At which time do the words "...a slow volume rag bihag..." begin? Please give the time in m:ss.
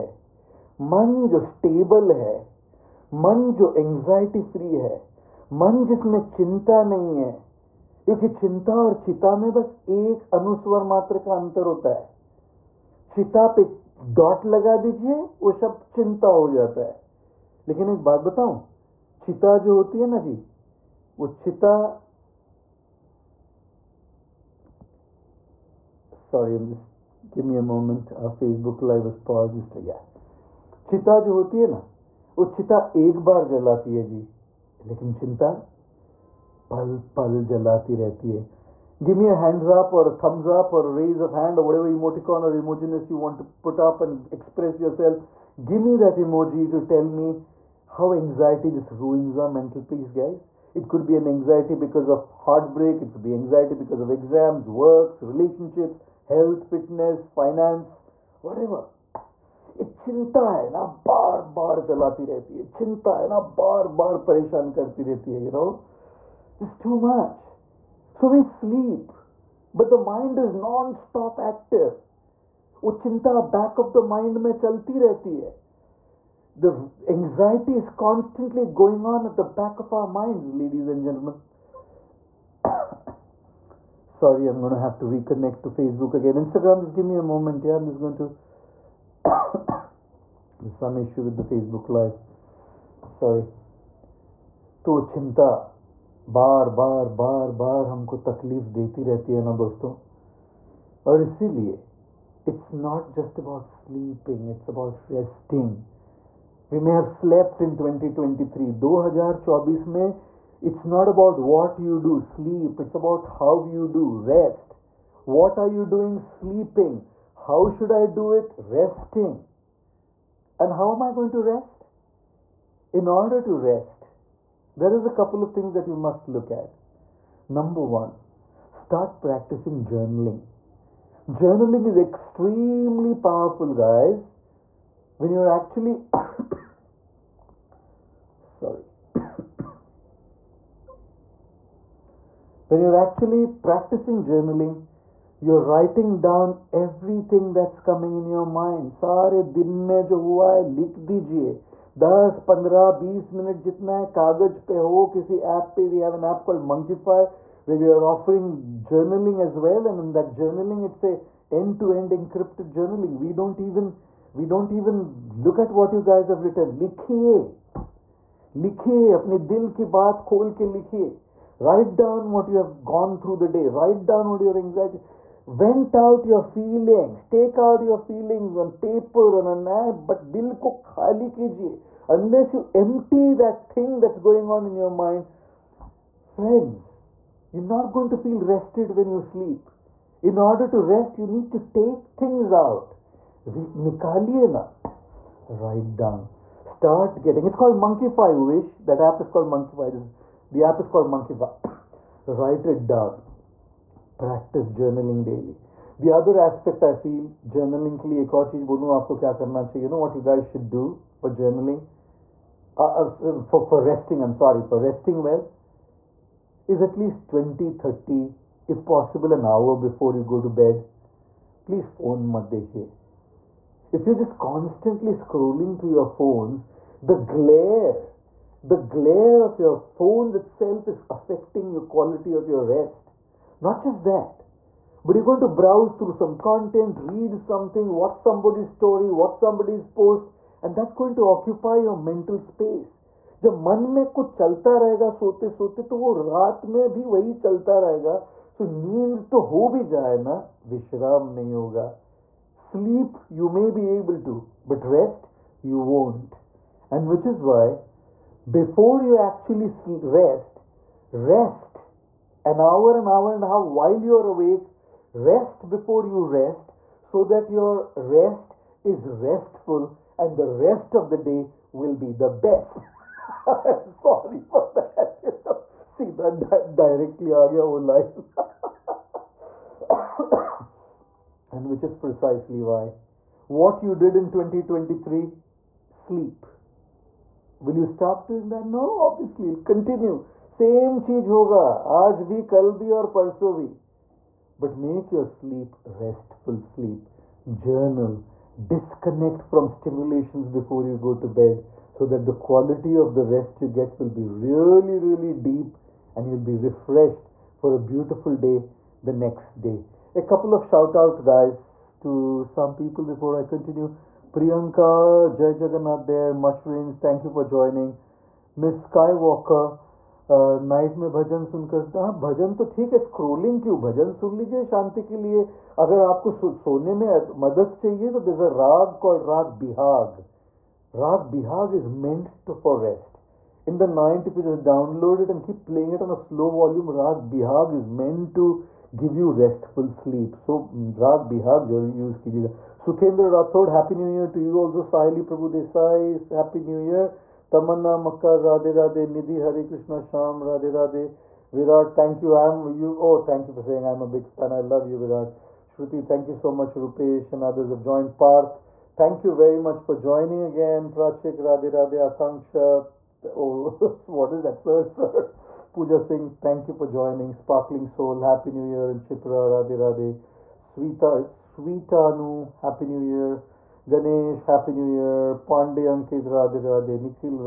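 5:36.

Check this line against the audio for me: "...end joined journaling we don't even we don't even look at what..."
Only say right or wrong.
wrong.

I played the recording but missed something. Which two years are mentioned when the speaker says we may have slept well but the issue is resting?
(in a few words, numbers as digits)
2023 and 2024.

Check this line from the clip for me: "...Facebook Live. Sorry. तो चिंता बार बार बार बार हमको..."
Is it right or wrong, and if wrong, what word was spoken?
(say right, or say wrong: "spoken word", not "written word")
right.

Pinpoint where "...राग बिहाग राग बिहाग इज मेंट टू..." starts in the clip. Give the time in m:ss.
5:29.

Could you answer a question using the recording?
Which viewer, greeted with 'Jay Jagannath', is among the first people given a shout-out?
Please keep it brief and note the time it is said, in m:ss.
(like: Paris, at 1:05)
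Priyanka, at 5:14.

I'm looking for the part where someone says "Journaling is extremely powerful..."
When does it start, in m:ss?
2:11.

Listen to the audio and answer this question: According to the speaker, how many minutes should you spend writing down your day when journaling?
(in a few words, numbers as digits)
10 15 20 minutes.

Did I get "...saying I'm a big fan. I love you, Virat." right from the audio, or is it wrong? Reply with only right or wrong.
right.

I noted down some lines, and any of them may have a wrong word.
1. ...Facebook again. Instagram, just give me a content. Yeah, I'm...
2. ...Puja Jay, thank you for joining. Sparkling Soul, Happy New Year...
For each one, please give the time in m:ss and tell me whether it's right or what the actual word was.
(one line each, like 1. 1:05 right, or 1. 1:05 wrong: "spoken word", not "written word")
1. 1:25 wrong: "moment", not "content"
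2. 6:05 wrong: "Singh", not "Jay".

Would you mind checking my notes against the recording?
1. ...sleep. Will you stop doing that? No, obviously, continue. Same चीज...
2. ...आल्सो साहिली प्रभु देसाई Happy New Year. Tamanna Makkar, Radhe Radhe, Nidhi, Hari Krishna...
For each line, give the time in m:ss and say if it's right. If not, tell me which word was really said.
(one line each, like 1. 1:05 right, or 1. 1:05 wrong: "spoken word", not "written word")
1. 4:45 right
2. 5:44 right.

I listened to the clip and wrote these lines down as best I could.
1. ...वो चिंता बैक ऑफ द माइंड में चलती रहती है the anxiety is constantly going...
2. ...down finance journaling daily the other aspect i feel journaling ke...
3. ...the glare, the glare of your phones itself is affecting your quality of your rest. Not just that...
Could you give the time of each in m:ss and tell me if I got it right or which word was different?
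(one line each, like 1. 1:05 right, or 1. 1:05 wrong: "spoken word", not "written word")
1. 1:12 right
2. 3:22 wrong: "practice", not "finance"
3. 3:47 right.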